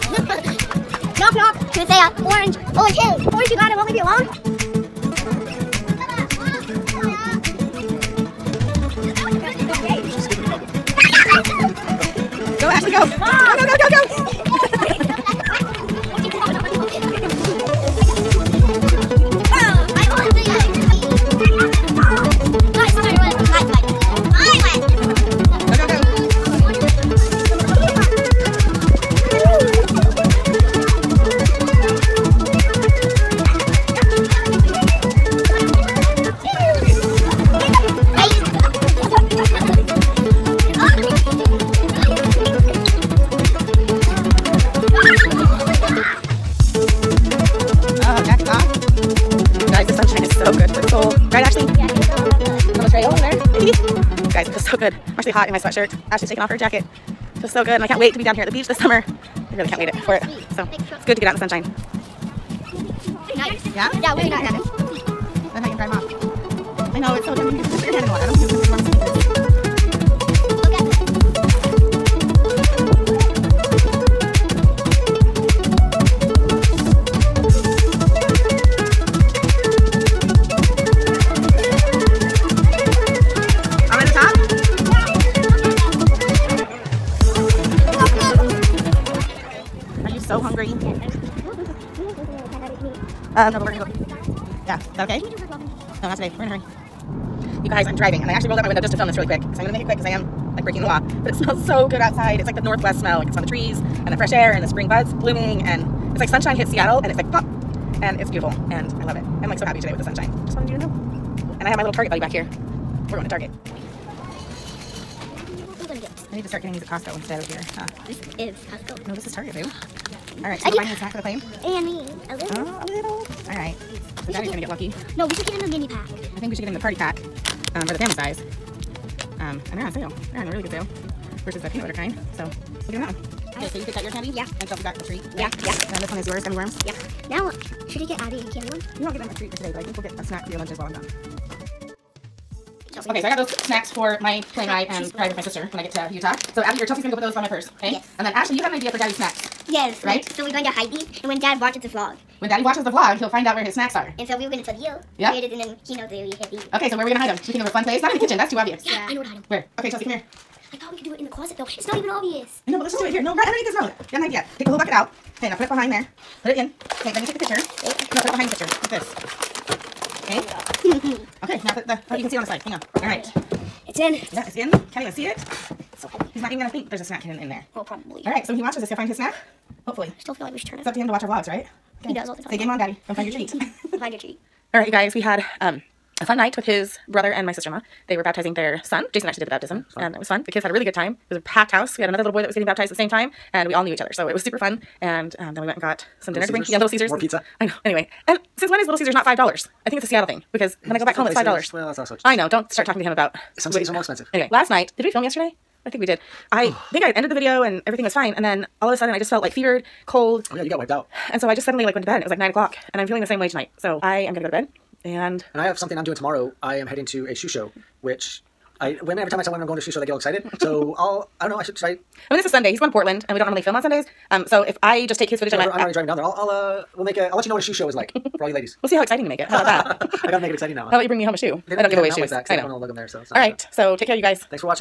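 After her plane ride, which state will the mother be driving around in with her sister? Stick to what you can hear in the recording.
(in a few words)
Utah.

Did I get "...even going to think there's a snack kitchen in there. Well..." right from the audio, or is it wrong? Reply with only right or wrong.
wrong.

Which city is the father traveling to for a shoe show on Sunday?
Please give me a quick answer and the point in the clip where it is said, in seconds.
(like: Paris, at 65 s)
Portland, at 222 s.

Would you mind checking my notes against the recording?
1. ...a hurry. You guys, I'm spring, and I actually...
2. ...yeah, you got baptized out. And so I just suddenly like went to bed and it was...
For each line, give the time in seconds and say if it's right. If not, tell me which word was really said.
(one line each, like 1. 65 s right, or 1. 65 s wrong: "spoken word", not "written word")
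1. 96 s wrong: "driving", not "spring"
2. 210 s wrong: "wiped", not "baptized".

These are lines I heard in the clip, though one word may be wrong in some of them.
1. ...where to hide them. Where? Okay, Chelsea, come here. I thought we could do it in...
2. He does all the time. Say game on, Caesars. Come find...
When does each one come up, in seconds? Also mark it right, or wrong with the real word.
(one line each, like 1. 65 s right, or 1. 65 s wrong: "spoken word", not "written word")
1. 159 s right
2. 182 s wrong: "Daddy", not "Caesars".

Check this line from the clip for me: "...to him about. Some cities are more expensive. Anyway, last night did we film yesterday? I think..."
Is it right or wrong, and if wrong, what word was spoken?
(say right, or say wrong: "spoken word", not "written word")
right.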